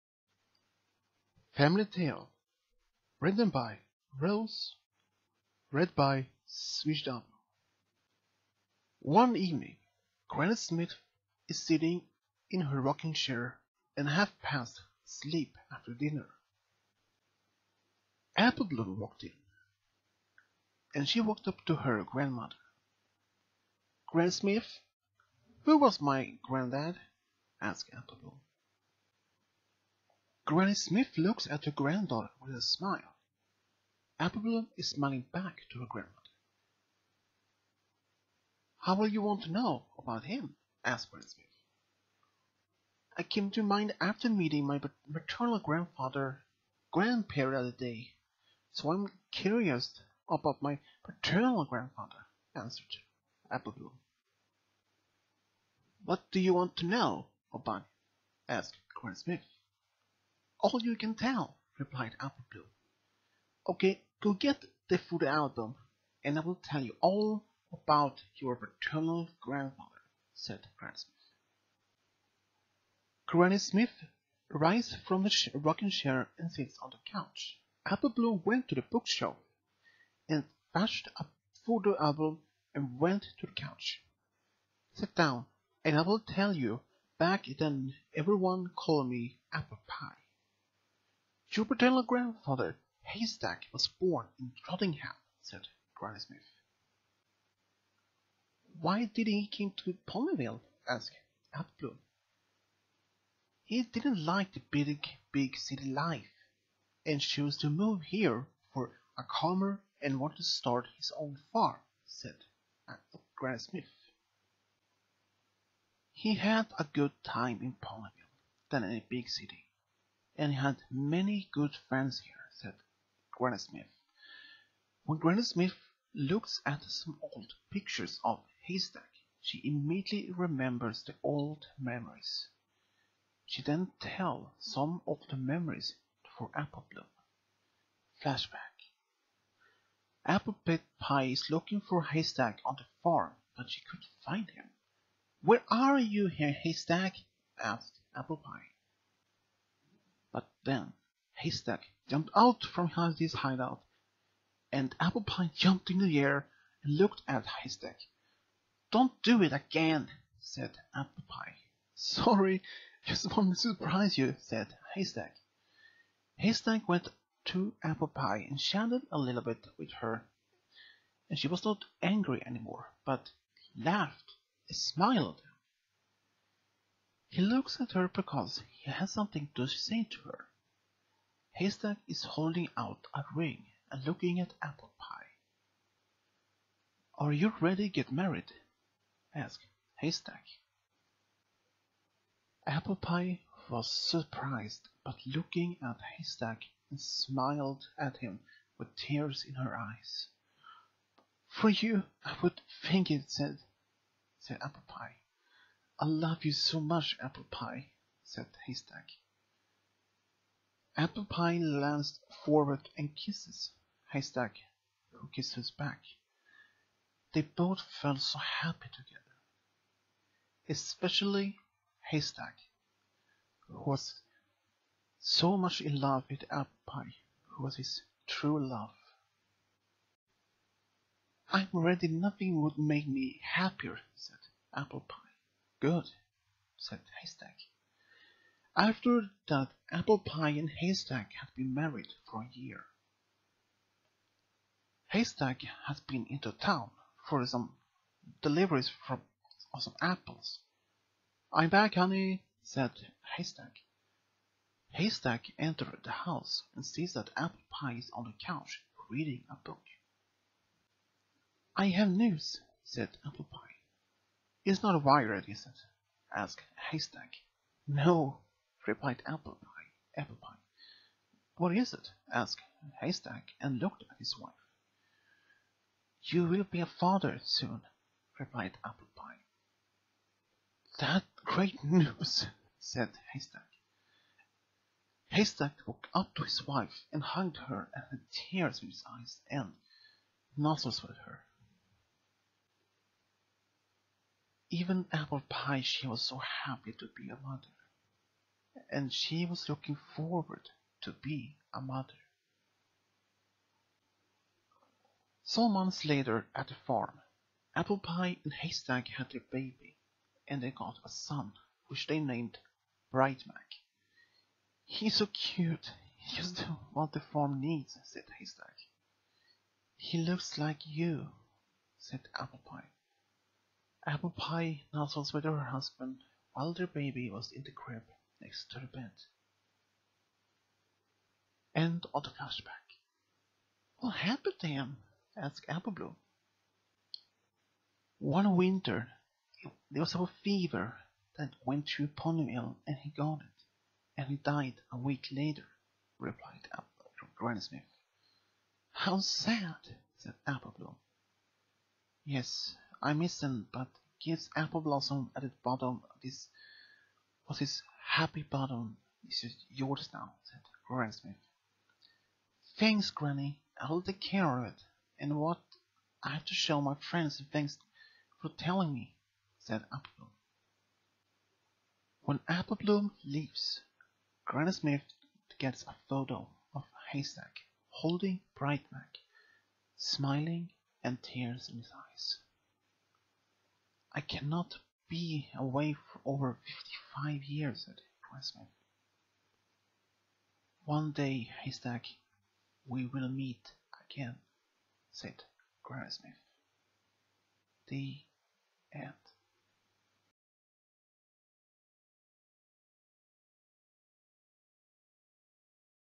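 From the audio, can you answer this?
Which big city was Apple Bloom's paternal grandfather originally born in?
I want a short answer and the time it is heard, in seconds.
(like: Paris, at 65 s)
Trottingham, at 94 s.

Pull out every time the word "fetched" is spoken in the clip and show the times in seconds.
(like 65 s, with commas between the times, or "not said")
80 s.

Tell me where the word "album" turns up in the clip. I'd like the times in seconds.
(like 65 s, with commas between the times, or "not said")
65 s, 81 s.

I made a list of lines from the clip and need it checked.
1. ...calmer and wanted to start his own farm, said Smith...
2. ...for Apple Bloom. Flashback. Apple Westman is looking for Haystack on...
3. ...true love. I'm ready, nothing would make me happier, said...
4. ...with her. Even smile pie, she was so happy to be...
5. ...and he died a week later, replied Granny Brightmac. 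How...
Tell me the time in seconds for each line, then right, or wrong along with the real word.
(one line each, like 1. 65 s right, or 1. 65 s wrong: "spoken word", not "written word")
1. 109 s wrong: "Granny", not "Smith"
2. 136 s wrong: "Pie", not "Westman"
3. 228 s right
4. 291 s wrong: "apple", not "smile"
5. 344 s wrong: "Smith", not "Brightmac".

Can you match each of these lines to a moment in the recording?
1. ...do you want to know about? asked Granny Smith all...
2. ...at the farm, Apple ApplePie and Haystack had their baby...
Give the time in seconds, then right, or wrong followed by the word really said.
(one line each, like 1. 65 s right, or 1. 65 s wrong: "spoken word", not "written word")
1. 56 s right
2. 306 s wrong: "Pie", not "ApplePie".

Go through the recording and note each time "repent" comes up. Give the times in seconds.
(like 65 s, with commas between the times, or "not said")
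328 s.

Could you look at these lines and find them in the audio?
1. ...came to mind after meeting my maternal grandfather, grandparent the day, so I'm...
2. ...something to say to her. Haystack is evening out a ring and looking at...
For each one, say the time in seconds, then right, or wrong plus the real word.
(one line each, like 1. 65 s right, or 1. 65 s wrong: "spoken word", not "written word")
1. 43 s right
2. 179 s wrong: "holding", not "evening".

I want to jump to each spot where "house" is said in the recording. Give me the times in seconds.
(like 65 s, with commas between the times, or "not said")
256 s.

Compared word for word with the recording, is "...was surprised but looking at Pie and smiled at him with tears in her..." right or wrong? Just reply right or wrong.
wrong.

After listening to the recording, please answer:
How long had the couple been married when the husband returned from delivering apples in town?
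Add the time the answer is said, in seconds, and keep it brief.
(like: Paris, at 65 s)
a year, at 242 s.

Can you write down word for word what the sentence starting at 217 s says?
They both felt so happy together.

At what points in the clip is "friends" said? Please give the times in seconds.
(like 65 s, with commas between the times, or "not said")
121 s, 367 s.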